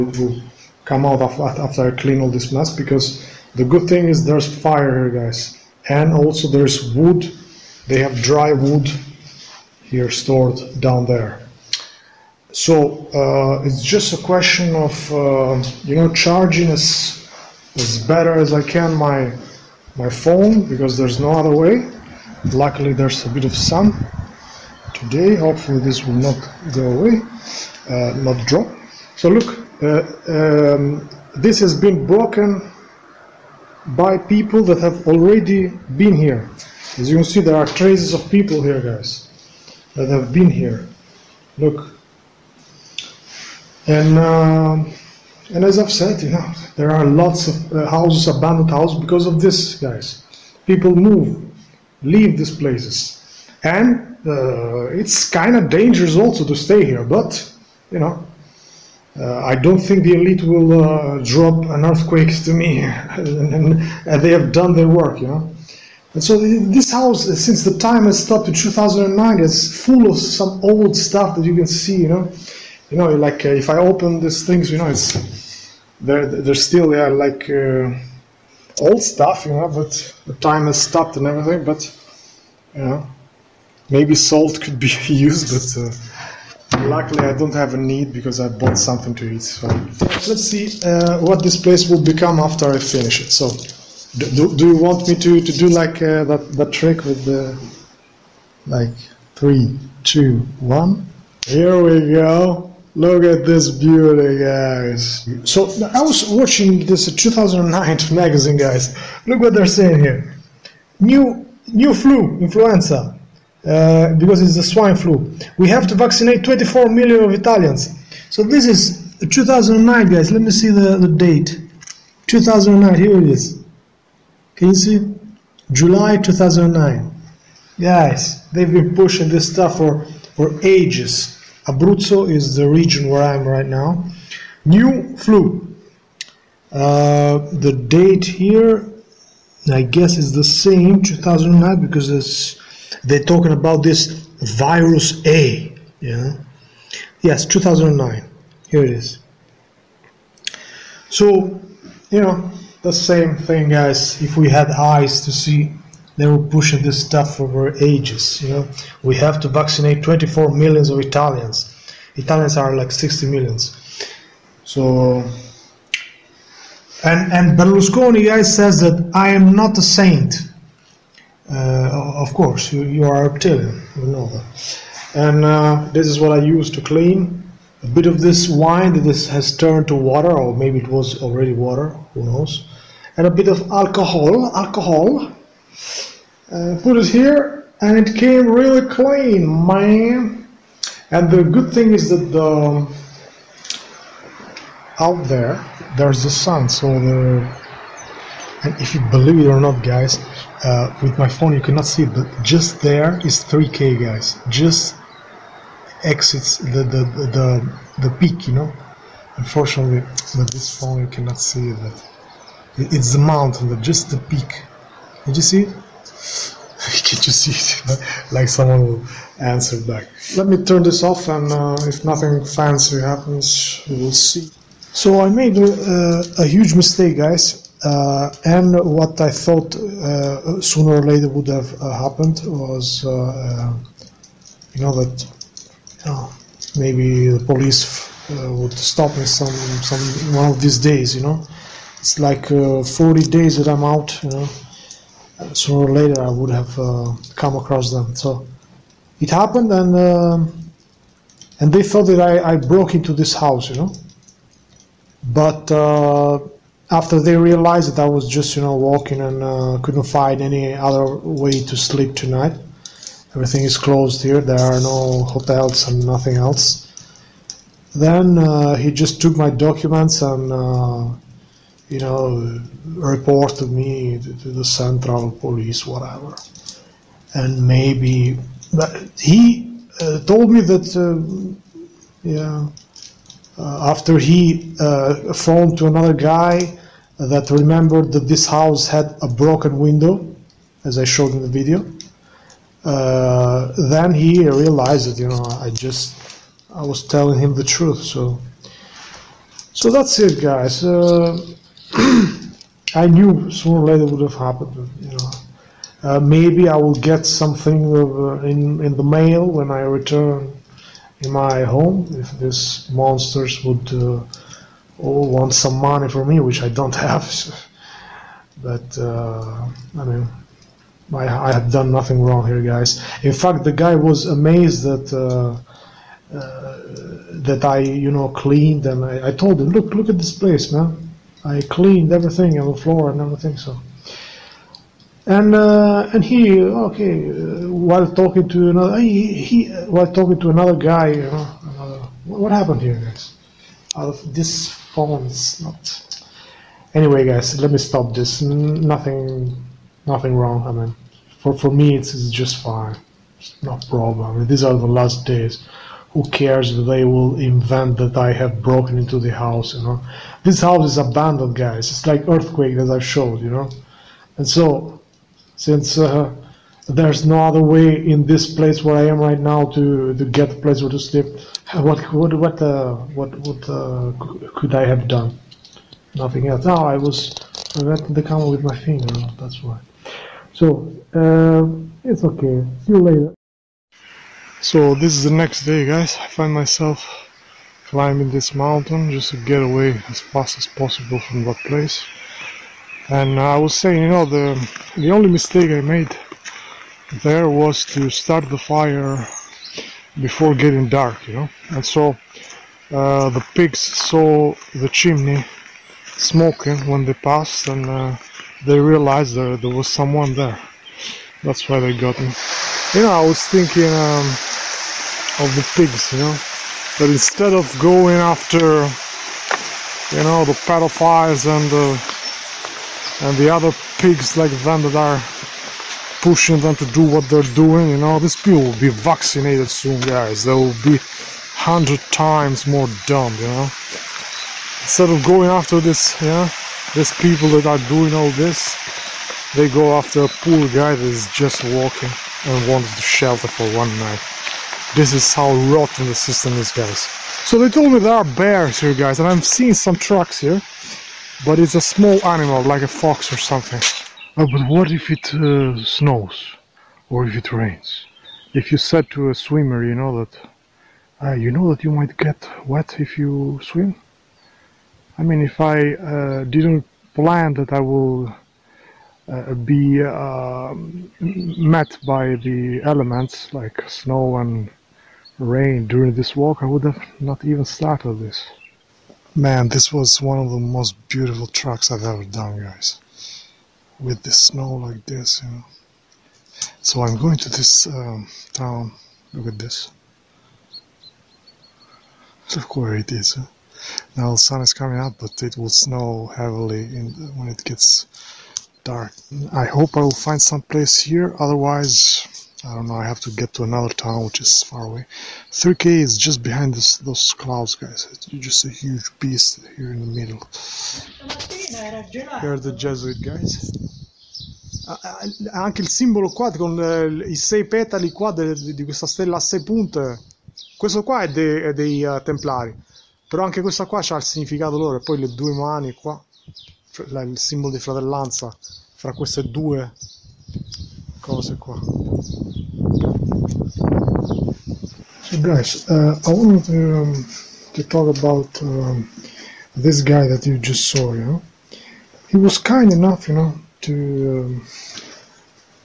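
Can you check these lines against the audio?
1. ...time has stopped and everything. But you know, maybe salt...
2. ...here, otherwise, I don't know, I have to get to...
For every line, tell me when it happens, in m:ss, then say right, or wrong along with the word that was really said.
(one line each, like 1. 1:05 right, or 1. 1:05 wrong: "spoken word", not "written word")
1. 1:20 right
2. 8:21 right.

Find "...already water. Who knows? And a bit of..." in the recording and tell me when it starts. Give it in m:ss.
3:01.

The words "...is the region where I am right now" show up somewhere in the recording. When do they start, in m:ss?
2:12.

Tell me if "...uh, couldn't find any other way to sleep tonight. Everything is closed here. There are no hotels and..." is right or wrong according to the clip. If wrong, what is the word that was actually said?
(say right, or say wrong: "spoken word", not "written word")
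right.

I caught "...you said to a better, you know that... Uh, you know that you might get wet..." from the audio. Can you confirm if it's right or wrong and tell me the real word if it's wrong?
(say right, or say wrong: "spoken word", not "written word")
wrong: "swimmer", not "better".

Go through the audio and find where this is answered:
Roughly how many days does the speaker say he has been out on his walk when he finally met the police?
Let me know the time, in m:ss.
4:02.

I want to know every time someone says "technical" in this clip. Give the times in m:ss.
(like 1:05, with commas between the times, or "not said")
not said.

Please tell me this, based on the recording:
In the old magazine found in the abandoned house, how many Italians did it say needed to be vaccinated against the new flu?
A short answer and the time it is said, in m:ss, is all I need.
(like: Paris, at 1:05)
24 million, at 1:56.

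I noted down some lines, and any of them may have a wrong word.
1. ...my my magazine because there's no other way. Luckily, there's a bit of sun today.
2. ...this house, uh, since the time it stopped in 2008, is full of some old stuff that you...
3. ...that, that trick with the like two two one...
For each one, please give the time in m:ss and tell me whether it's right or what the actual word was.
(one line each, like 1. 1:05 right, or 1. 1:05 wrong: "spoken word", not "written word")
1. 0:18 wrong: "phone", not "magazine"
2. 1:06 wrong: "2009", not "2008"
3. 1:36 wrong: "three", not "two".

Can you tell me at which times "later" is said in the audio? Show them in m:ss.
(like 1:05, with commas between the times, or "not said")
3:51, 4:05, 5:03, 6:23.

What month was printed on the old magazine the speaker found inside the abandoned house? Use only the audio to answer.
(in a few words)
July.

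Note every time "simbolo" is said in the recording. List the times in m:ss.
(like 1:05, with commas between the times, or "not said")
8:35, 8:47.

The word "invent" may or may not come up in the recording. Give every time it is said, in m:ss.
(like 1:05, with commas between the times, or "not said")
5:57.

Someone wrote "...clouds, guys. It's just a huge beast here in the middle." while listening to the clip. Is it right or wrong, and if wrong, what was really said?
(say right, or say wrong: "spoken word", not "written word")
right.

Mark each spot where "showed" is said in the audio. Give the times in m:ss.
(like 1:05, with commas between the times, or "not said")
4:51, 6:03.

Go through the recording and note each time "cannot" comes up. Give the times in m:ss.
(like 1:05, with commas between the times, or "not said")
3:21, 3:31.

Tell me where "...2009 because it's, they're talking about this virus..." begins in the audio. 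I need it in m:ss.
2:21.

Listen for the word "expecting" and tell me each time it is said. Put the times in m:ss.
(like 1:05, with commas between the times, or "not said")
not said.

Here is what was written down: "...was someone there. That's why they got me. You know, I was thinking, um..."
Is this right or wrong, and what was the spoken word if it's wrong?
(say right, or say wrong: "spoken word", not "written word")
right.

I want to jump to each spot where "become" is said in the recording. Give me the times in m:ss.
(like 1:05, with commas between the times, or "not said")
1:32.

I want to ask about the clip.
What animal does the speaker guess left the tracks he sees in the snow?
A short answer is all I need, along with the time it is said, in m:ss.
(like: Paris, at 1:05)
A fox, at 7:32.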